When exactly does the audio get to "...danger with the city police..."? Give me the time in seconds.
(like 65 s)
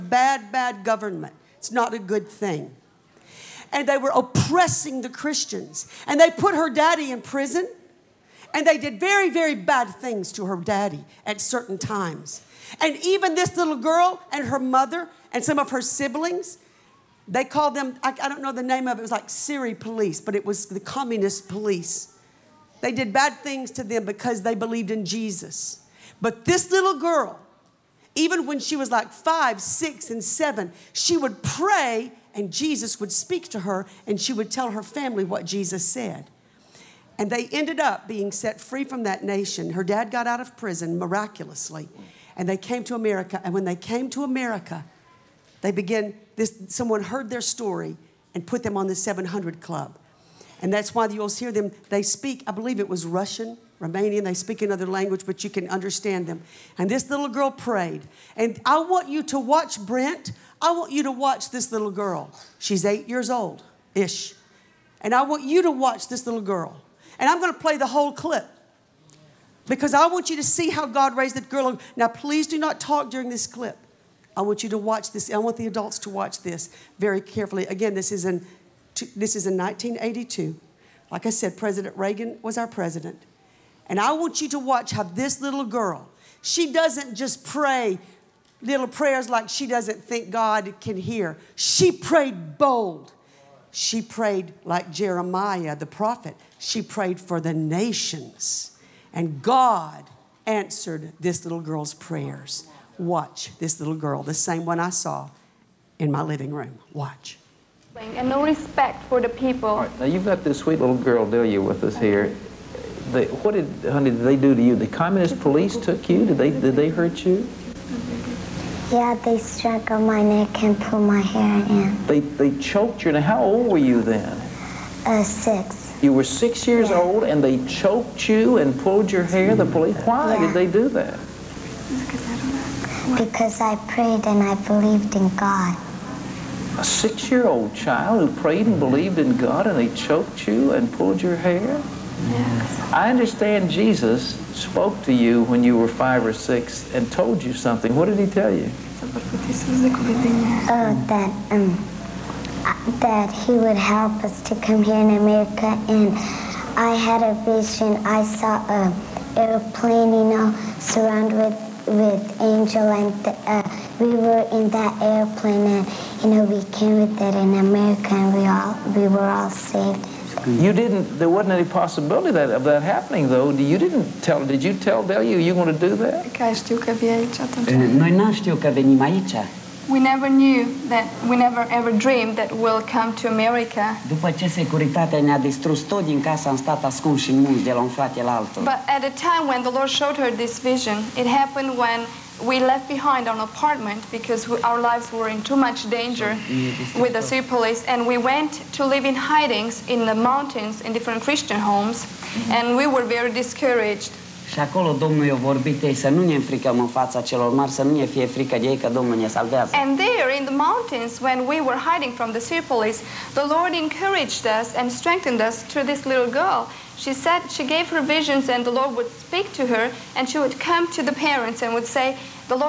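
195 s.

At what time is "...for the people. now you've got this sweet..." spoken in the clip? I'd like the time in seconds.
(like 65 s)
109 s.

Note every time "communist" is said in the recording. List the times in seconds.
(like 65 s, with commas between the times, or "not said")
20 s, 114 s.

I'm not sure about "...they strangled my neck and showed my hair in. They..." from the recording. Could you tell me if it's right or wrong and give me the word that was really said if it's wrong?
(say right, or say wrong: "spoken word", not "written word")
wrong: "pulled", not "showed".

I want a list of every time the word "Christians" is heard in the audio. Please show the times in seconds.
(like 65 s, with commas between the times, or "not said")
5 s, 201 s.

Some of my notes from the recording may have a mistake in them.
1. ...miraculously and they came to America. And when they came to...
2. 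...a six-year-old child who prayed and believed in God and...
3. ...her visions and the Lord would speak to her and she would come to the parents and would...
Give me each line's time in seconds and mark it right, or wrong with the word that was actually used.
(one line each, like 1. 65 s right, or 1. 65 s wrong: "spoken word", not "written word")
1. 40 s right
2. 136 s right
3. 217 s right.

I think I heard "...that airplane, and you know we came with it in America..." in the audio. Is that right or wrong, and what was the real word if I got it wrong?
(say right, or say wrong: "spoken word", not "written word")
right.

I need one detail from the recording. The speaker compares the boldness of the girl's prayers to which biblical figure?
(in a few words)
Jeremiah.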